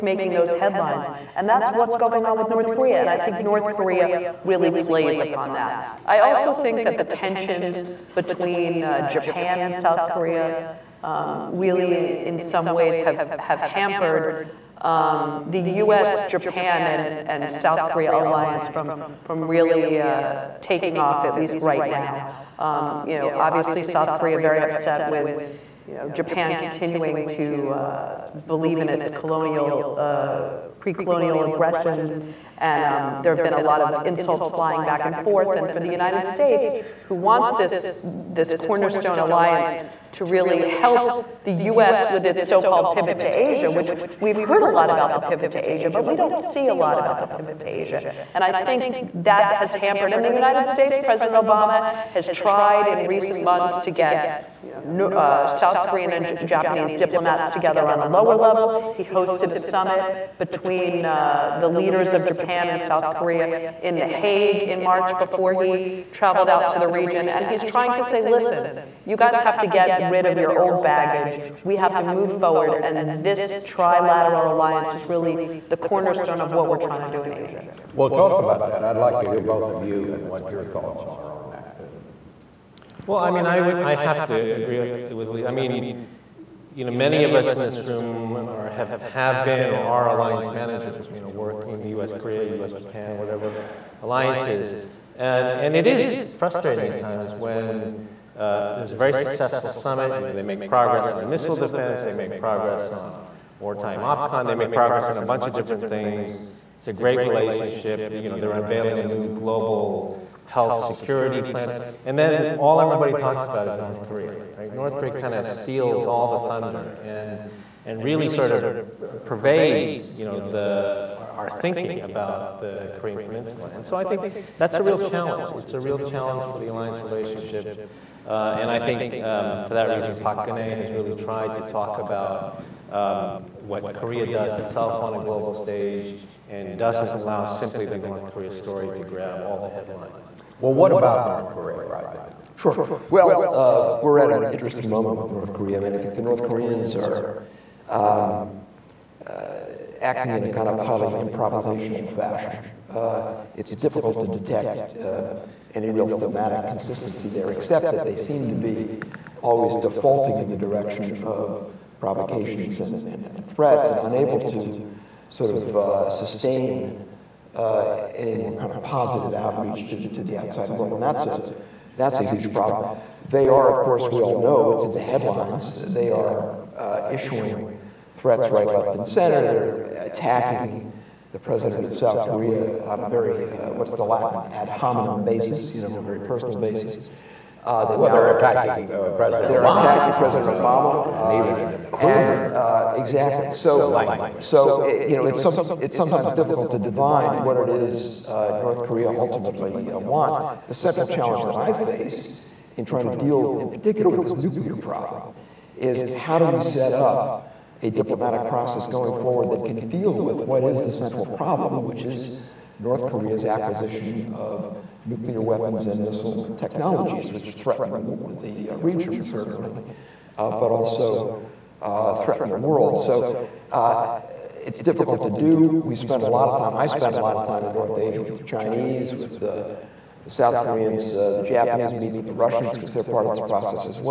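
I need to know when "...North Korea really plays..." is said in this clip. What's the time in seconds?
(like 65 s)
3 s.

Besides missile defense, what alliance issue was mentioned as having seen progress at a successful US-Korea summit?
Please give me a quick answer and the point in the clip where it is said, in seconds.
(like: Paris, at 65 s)
wartime OPCON, at 103 s.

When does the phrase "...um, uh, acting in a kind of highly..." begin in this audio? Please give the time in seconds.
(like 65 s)
147 s.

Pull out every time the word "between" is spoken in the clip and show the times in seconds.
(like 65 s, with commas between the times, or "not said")
8 s, 60 s.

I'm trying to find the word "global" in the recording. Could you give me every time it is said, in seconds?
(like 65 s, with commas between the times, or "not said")
109 s, 135 s.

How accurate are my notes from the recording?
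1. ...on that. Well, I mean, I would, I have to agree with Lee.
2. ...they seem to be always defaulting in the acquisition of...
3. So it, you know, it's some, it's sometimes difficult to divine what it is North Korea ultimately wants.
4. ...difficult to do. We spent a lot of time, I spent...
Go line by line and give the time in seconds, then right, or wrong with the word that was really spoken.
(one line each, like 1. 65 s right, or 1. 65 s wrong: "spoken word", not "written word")
1. 81 s right
2. 158 s wrong: "direction", not "acquisition"
3. 194 s right
4. 224 s right.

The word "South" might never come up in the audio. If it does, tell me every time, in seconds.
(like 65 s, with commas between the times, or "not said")
9 s, 17 s, 23 s, 55 s, 62 s, 181 s, 230 s.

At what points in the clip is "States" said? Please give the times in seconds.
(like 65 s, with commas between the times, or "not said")
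36 s, 50 s.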